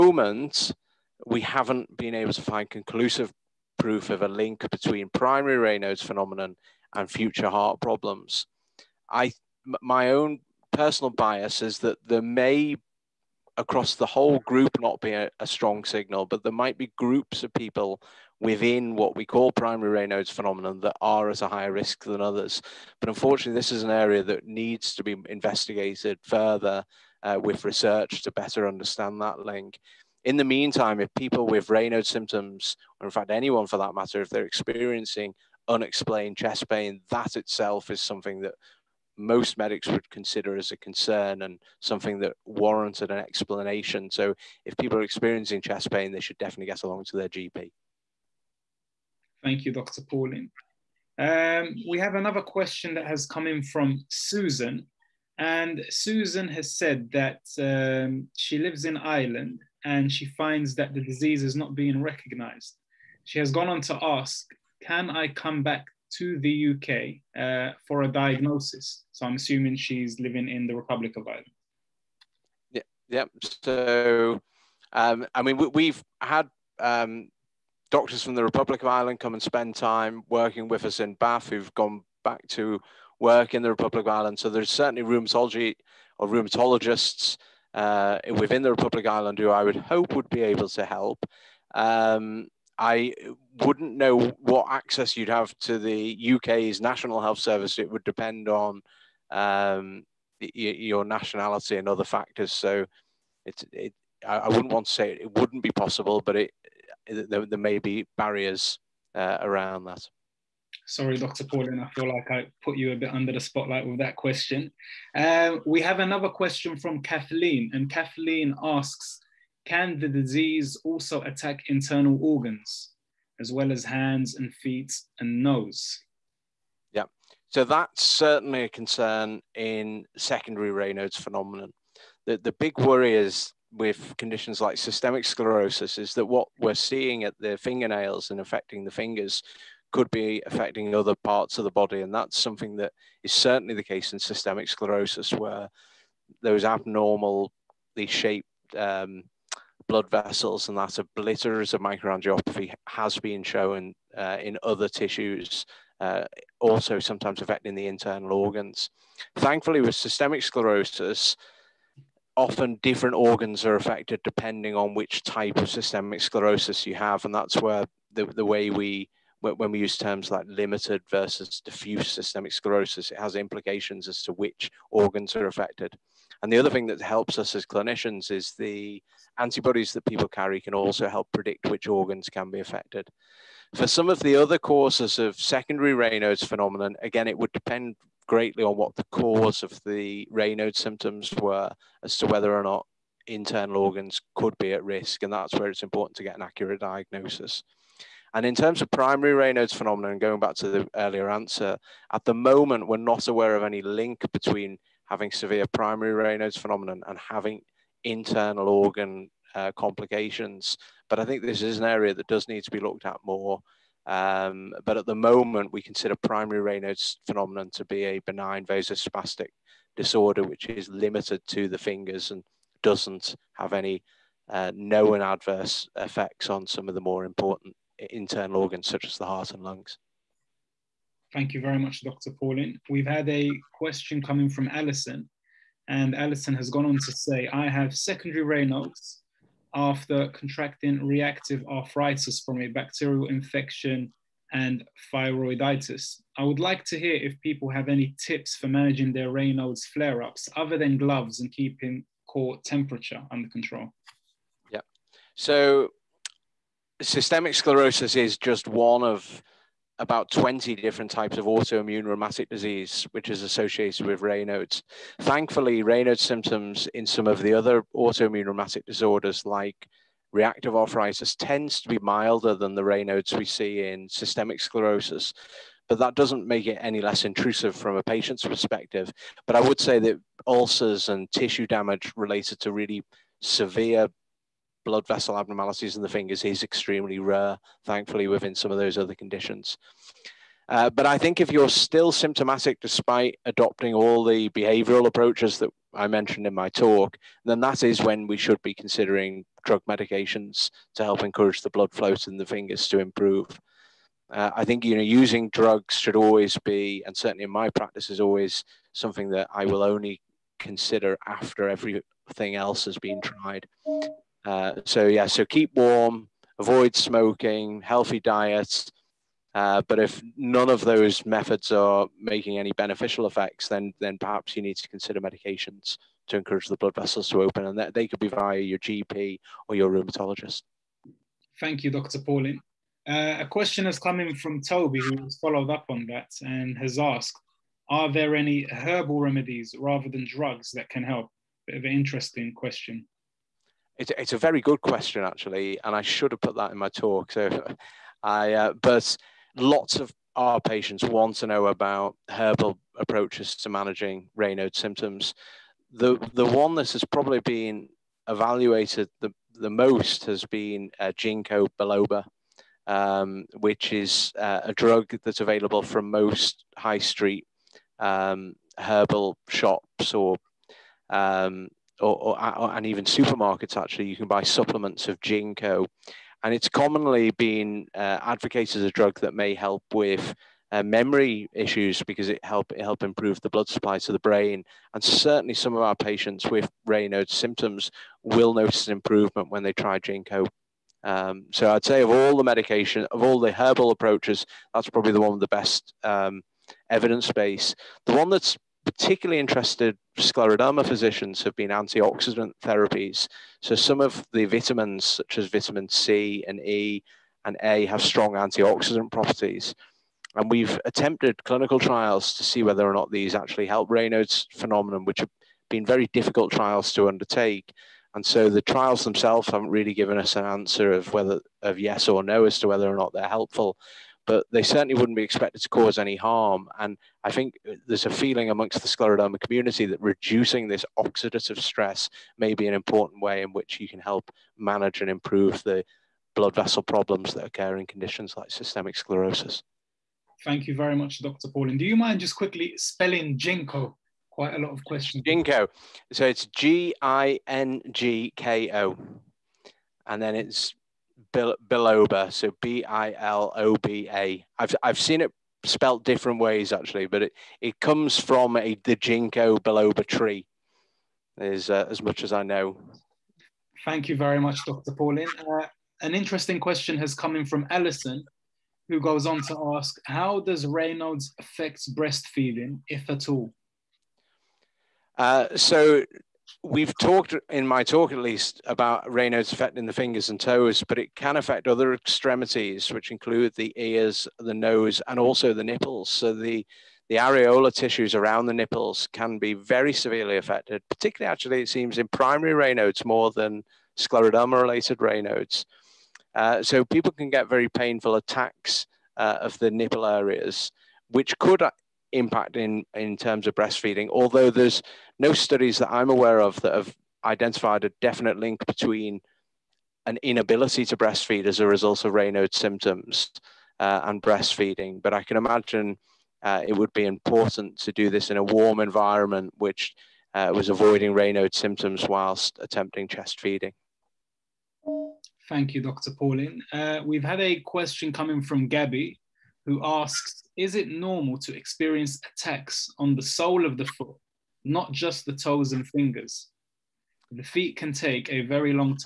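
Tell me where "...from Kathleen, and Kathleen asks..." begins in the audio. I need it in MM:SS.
01:56.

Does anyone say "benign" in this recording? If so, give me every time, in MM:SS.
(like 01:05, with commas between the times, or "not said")
03:38.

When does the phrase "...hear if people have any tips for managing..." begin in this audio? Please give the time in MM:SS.
04:06.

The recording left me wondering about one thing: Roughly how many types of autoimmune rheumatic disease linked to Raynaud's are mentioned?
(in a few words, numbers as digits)
about 20.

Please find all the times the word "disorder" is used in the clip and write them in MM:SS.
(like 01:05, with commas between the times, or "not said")
03:39, 04:28.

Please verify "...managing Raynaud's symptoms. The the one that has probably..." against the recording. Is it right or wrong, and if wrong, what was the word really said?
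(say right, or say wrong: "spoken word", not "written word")
right.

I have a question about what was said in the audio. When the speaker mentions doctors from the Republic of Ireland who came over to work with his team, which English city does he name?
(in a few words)
Bath.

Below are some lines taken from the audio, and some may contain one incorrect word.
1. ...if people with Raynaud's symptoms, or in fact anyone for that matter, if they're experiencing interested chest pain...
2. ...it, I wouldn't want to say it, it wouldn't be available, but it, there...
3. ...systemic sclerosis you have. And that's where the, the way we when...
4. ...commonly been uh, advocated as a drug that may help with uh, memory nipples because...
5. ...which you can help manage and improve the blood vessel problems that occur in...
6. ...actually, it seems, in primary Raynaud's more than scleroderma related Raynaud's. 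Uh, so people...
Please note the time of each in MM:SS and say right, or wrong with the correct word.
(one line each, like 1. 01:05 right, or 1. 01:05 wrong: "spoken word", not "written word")
1. 00:30 wrong: "unexplained", not "interested"
2. 01:43 wrong: "possible", not "available"
3. 02:45 right
4. 06:16 wrong: "issues", not "nipples"
5. 07:13 right
6. 08:11 right.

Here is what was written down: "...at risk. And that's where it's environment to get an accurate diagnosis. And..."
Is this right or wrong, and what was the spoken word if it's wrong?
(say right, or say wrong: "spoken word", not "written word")
wrong: "important", not "environment".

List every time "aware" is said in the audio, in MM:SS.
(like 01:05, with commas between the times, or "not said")
03:23, 08:26.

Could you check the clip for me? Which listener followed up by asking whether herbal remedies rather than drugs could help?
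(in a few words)
Toby.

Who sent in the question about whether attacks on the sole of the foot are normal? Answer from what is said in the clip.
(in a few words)
Gabby.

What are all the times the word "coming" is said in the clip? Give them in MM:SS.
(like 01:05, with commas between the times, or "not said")
03:54, 08:48.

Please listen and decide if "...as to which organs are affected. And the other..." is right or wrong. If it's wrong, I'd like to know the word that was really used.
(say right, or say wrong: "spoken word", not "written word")
right.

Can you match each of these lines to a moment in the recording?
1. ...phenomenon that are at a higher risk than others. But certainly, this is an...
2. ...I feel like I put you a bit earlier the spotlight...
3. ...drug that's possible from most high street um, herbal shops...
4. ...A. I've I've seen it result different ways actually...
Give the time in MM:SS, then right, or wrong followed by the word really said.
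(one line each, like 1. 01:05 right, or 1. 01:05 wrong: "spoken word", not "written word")
1. 00:20 wrong: "unfortunately", not "certainly"
2. 01:51 wrong: "under", not "earlier"
3. 06:04 wrong: "available", not "possible"
4. 07:34 wrong: "spelt", not "result".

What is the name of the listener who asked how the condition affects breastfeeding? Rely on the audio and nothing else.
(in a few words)
Ellison.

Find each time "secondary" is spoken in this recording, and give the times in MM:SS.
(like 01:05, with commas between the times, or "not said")
02:10, 03:05, 03:57.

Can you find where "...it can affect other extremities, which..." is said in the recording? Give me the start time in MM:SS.
08:00.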